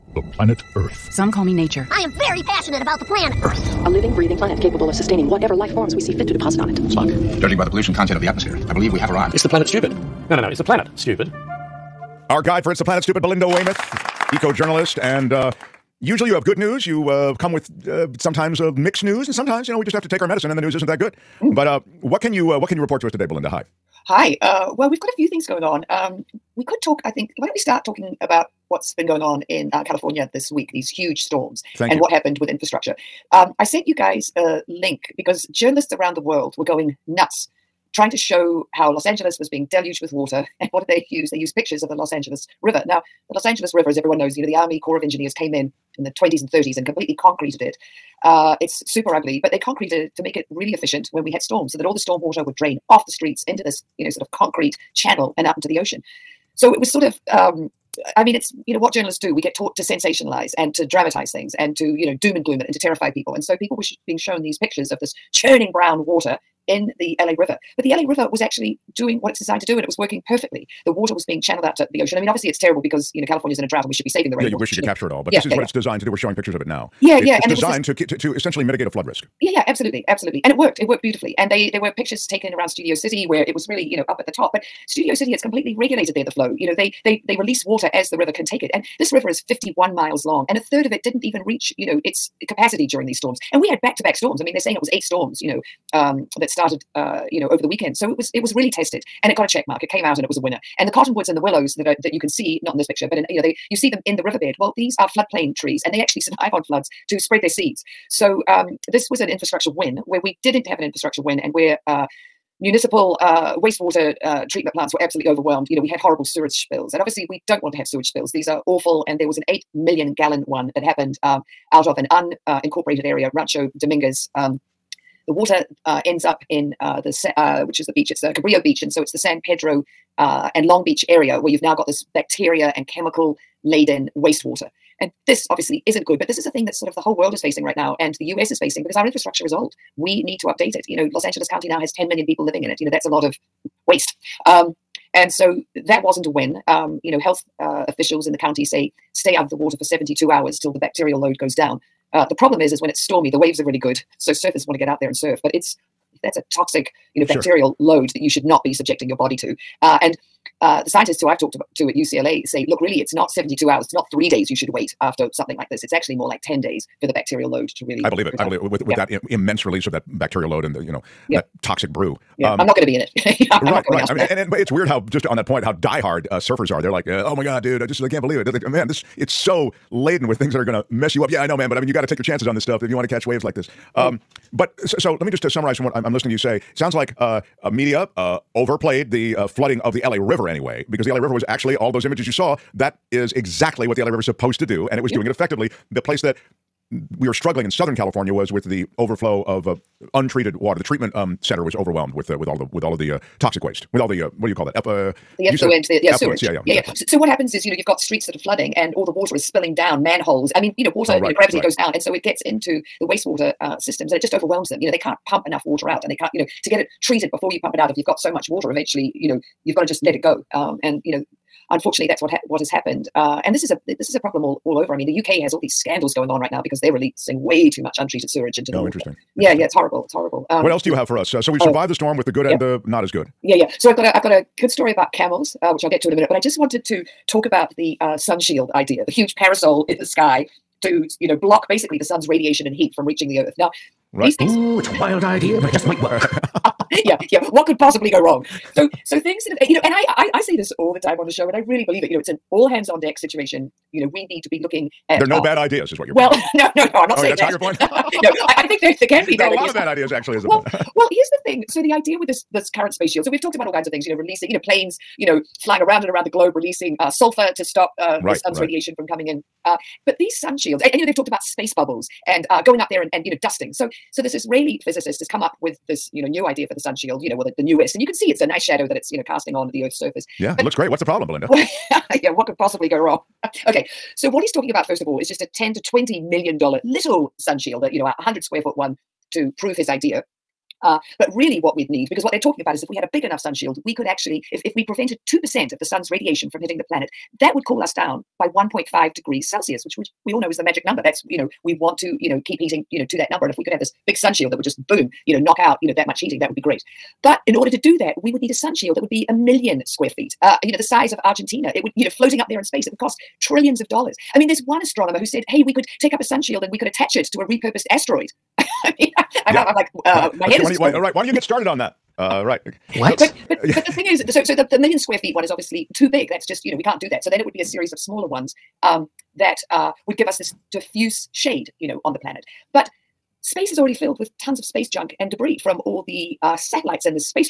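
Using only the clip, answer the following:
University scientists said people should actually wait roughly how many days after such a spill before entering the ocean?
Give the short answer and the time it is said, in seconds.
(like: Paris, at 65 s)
10 days, at 166 s.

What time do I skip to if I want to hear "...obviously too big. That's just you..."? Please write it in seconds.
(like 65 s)
325 s.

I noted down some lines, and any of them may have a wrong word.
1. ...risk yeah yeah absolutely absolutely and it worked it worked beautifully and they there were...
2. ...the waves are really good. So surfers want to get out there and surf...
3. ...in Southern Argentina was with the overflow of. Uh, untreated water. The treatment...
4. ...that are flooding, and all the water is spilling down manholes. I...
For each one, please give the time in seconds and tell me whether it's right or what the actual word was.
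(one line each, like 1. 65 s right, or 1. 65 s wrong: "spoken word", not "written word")
1. 79 s right
2. 153 s right
3. 197 s wrong: "California", not "Argentina"
4. 208 s right.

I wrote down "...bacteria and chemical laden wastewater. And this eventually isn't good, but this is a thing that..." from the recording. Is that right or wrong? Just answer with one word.
wrong.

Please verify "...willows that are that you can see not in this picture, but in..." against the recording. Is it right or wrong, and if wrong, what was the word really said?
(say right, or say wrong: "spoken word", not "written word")
right.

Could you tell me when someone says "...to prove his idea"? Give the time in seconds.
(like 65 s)
289 s.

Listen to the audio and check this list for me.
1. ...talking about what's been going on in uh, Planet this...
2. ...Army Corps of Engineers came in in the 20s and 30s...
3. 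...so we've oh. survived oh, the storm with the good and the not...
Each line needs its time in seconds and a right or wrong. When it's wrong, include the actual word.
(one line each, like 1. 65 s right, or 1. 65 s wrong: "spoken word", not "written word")
1. 27 s wrong: "California", not "Planet"
2. 44 s right
3. 231 s right.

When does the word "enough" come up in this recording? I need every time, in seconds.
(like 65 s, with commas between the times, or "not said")
215 s, 293 s.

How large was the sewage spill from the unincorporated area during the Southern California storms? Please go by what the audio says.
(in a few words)
8 million gallons.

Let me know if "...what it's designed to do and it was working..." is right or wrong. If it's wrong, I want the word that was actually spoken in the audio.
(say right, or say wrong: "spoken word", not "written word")
right.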